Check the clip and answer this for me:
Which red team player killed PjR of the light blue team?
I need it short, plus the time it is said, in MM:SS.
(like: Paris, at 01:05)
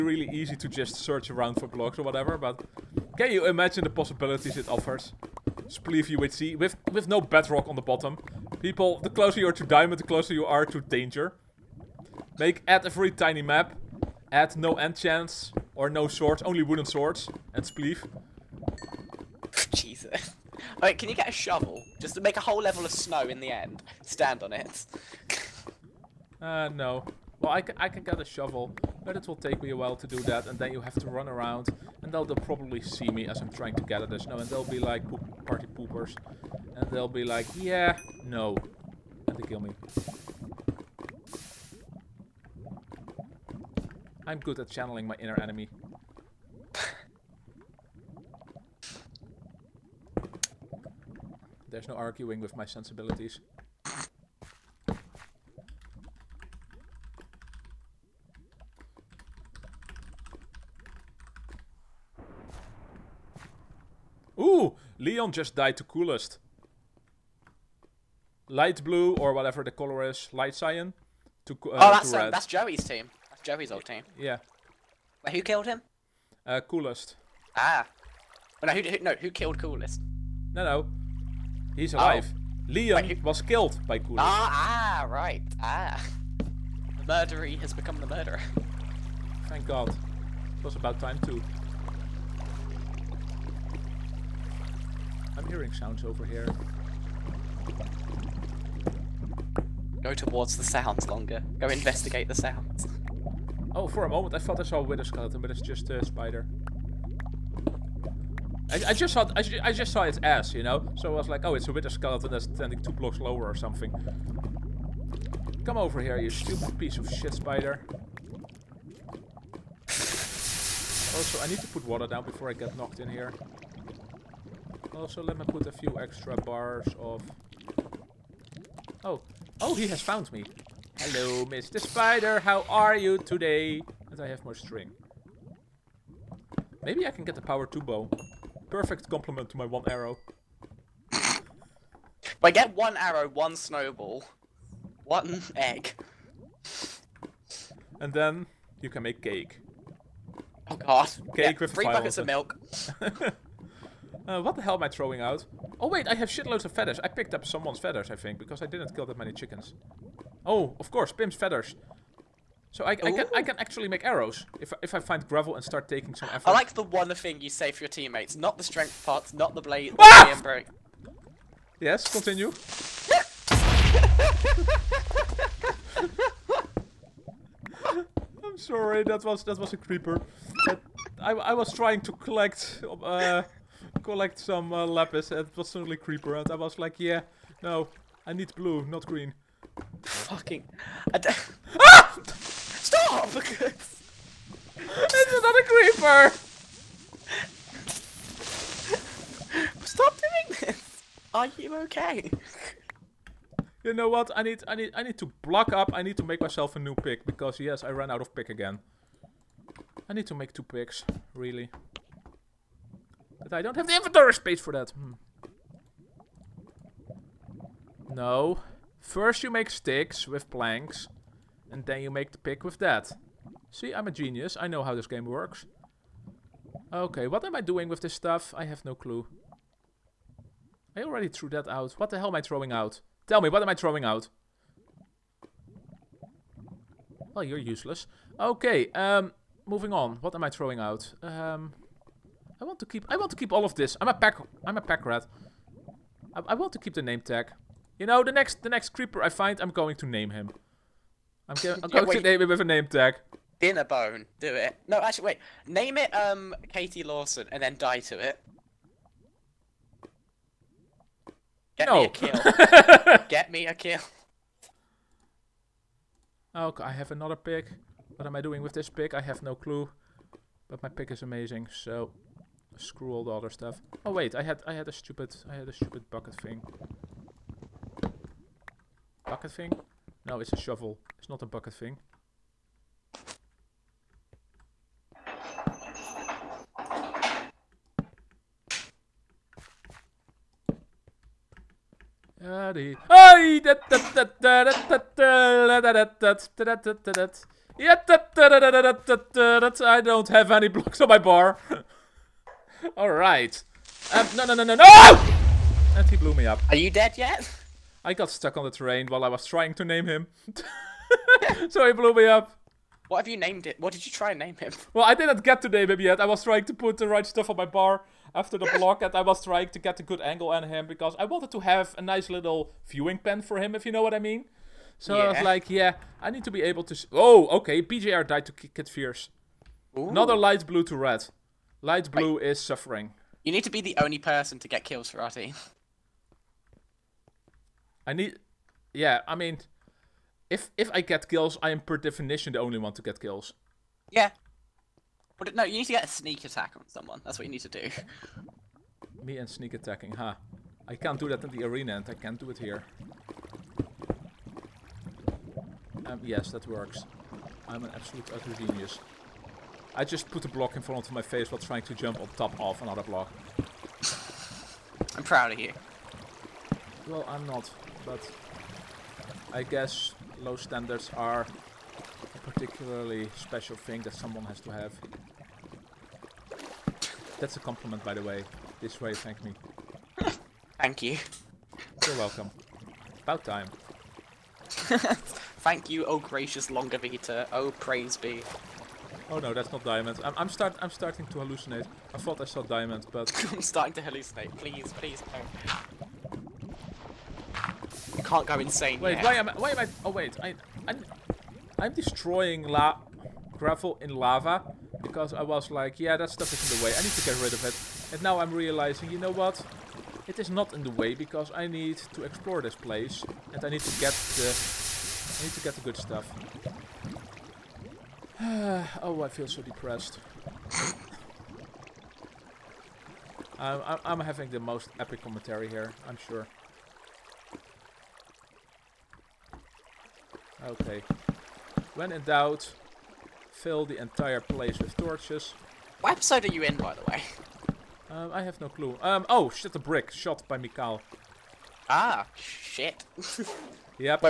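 Kid Fierce, at 05:28.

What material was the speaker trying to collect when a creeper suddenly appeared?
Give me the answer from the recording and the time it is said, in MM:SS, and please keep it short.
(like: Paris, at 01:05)
Lapis, at 03:04.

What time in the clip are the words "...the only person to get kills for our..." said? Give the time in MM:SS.
05:33.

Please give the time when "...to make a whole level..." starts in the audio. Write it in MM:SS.
00:22.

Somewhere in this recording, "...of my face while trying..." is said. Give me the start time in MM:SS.
06:01.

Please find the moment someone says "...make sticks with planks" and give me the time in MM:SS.
03:39.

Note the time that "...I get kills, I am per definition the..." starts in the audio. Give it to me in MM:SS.
05:40.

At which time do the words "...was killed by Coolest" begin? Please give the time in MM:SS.
01:23.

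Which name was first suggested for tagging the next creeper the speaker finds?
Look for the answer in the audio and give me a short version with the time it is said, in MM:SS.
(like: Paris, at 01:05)
Dinnerbone, at 04:13.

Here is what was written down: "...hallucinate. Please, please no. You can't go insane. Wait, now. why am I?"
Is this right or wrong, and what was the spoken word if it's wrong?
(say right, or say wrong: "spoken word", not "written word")
right.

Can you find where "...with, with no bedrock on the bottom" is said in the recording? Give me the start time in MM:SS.
00:06.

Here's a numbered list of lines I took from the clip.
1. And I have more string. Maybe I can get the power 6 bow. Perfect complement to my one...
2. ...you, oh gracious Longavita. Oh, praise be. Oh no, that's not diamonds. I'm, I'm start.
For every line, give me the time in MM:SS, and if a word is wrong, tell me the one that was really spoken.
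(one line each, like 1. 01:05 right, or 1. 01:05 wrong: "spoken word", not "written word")
1. 02:14 wrong: "2", not "6"
2. 06:25 right.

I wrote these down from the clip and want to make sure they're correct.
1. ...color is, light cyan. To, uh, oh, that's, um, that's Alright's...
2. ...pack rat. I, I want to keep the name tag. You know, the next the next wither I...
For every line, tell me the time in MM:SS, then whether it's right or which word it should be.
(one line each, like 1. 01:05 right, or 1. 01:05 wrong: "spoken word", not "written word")
1. 01:09 wrong: "Joey", not "Alright"
2. 04:04 wrong: "creeper", not "wither".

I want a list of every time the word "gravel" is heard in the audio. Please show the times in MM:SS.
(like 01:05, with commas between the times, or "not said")
02:45, 06:43.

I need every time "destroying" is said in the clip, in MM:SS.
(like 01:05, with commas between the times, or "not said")
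06:41.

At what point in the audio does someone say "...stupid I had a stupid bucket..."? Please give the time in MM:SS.
04:34.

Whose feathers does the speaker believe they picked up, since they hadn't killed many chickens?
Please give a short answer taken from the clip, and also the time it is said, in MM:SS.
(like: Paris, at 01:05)
Pim's, at 02:41.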